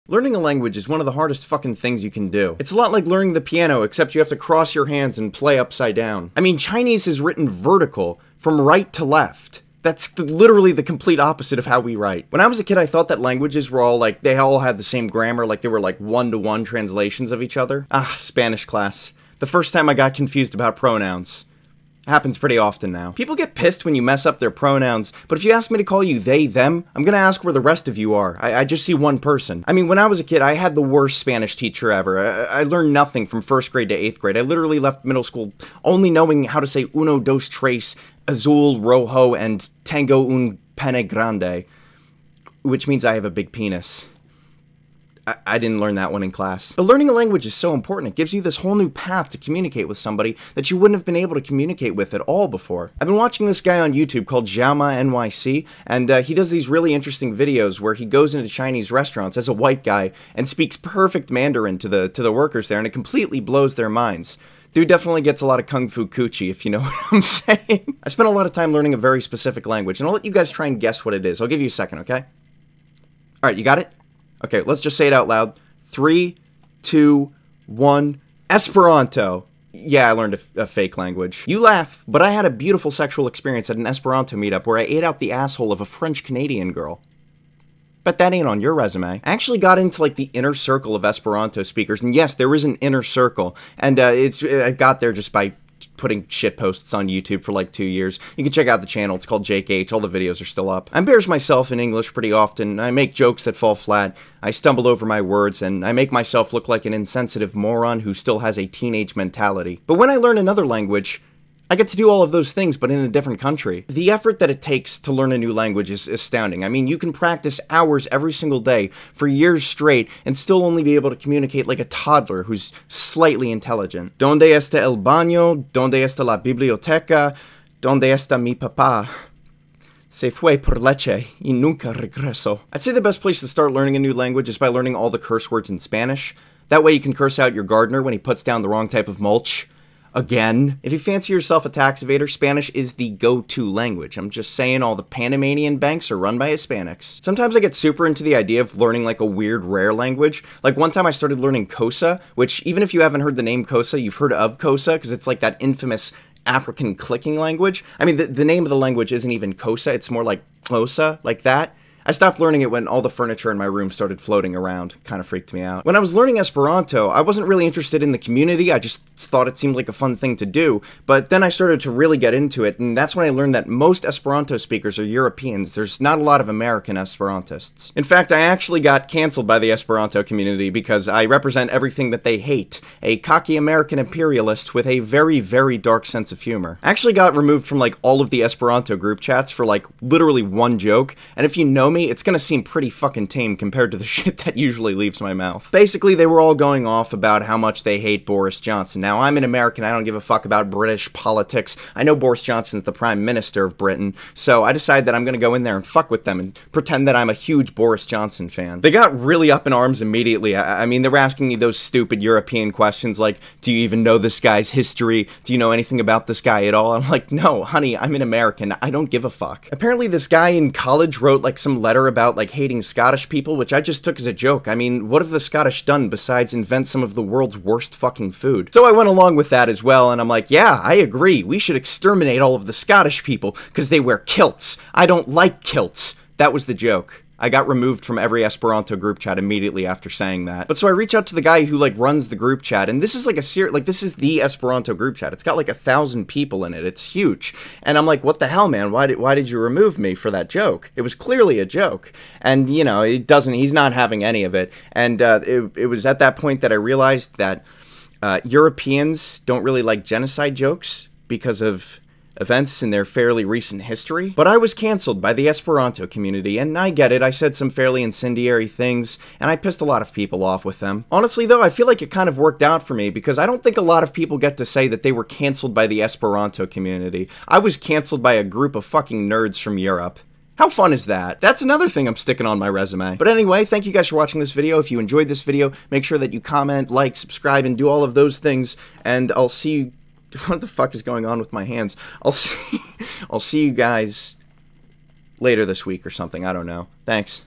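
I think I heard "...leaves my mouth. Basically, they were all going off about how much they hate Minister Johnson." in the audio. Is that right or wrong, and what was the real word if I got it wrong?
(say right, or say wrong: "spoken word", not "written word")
wrong: "Boris", not "Minister".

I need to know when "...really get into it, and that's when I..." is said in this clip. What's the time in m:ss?
2:51.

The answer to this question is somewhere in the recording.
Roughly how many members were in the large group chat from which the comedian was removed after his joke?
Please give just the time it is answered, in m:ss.
4:05.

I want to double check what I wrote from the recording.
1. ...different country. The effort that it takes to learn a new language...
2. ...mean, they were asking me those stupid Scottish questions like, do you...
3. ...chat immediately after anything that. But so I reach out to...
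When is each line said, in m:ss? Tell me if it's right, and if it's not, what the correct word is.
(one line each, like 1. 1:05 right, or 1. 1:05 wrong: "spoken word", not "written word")
1. 1:53 right
2. 3:30 wrong: "European", not "Scottish"
3. 3:59 wrong: "saying", not "anything".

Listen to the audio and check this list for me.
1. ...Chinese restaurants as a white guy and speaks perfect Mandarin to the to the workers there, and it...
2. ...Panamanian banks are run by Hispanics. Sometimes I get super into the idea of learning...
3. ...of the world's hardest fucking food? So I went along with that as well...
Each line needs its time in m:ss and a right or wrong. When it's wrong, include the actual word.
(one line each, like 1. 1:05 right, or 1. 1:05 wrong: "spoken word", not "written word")
1. 0:58 right
2. 2:25 right
3. 3:47 wrong: "worst", not "hardest".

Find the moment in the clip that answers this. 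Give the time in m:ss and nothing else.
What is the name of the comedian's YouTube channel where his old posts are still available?
1:39.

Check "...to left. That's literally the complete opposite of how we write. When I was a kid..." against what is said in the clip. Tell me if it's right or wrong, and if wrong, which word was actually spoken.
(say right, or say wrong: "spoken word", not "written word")
right.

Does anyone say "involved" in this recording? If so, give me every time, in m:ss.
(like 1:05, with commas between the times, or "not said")
not said.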